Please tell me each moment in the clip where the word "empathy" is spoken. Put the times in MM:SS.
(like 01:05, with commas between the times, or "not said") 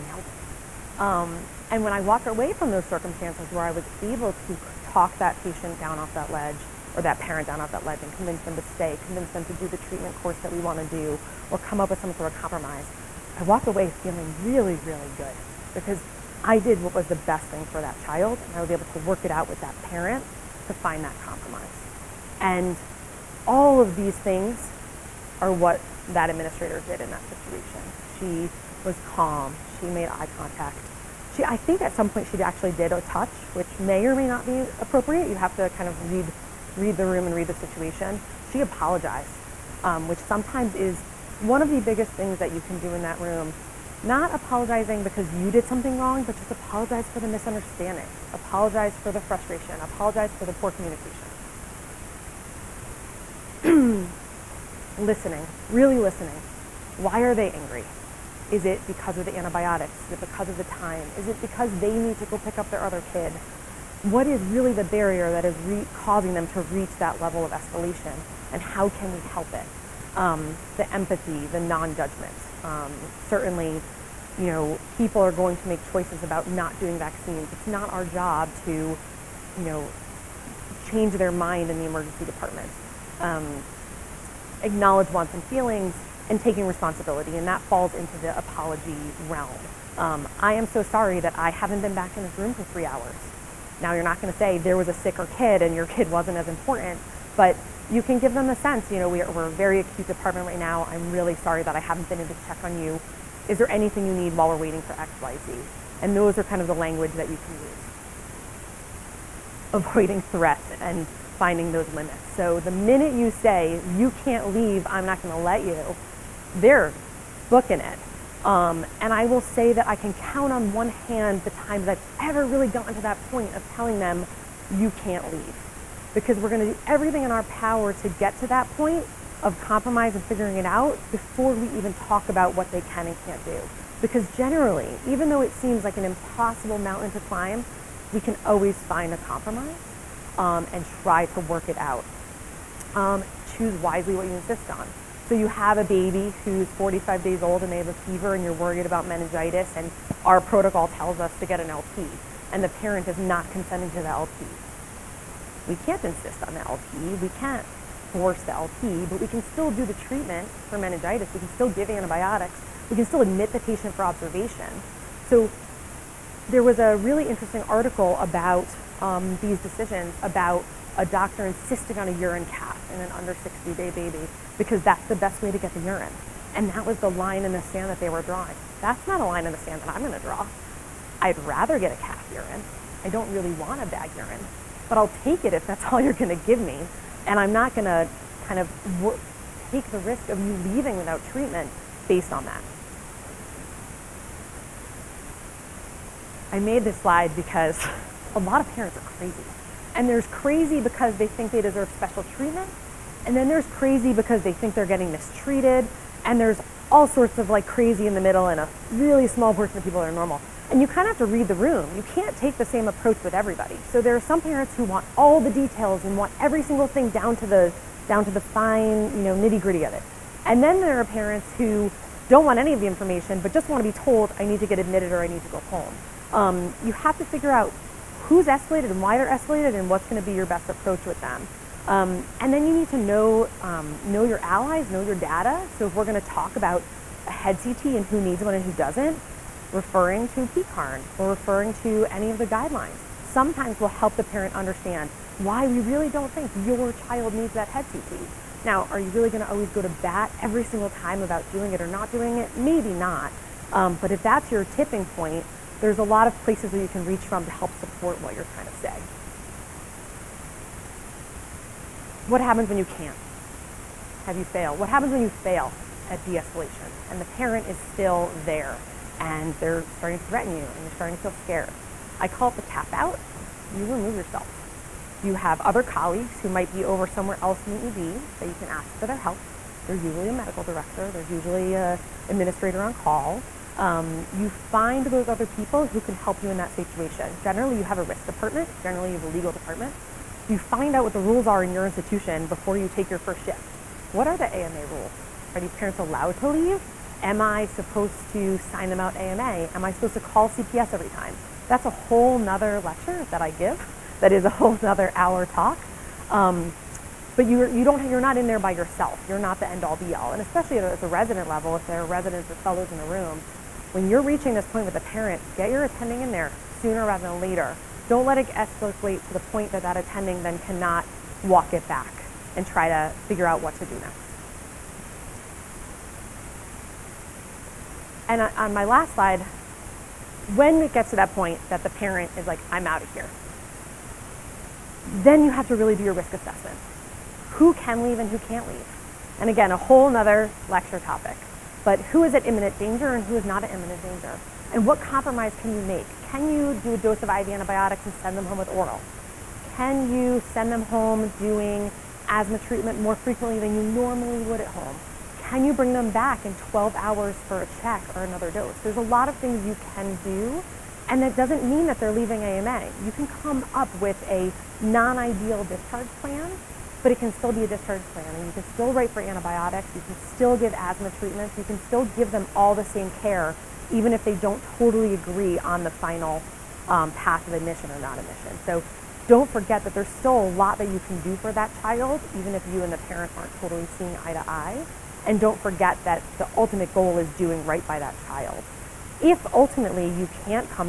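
01:10.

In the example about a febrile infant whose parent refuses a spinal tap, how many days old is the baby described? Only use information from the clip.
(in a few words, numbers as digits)
45.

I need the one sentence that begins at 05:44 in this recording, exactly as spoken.
And what compromise can you make?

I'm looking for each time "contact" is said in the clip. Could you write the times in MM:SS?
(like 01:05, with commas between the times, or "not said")
00:30.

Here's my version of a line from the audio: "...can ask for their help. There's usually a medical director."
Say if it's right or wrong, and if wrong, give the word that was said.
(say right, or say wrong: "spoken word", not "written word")
right.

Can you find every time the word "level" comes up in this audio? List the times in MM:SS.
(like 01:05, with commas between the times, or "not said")
01:07, 05:11.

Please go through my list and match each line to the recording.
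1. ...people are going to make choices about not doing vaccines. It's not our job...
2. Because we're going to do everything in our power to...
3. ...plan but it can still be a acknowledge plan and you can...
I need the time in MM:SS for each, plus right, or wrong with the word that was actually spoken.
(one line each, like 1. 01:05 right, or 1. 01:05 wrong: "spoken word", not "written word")
1. 01:14 right
2. 02:06 right
3. 06:06 wrong: "discharge", not "acknowledge".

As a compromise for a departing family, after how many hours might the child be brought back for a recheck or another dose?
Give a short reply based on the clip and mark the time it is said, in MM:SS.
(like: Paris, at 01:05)
12, at 05:56.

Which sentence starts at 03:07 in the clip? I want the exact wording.
And I'm not going to kind of take the risk of you leaving without treatment based on that.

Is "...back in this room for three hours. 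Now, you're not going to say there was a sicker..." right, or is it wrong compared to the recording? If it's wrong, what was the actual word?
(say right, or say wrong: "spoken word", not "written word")
right.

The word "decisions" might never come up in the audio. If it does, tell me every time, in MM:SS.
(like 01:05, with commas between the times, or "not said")
02:49.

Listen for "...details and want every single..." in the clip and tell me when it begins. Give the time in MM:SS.
03:35.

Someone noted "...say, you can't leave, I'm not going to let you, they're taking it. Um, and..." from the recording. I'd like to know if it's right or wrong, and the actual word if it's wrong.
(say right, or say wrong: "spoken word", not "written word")
wrong: "booking", not "taking".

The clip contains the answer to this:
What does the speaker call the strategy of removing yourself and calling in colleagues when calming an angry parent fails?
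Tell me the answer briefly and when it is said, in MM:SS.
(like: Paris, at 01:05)
The tap out, at 04:32.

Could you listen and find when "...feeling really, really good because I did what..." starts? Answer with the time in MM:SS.
00:14.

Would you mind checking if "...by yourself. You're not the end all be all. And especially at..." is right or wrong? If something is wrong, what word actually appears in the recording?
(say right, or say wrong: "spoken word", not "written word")
right.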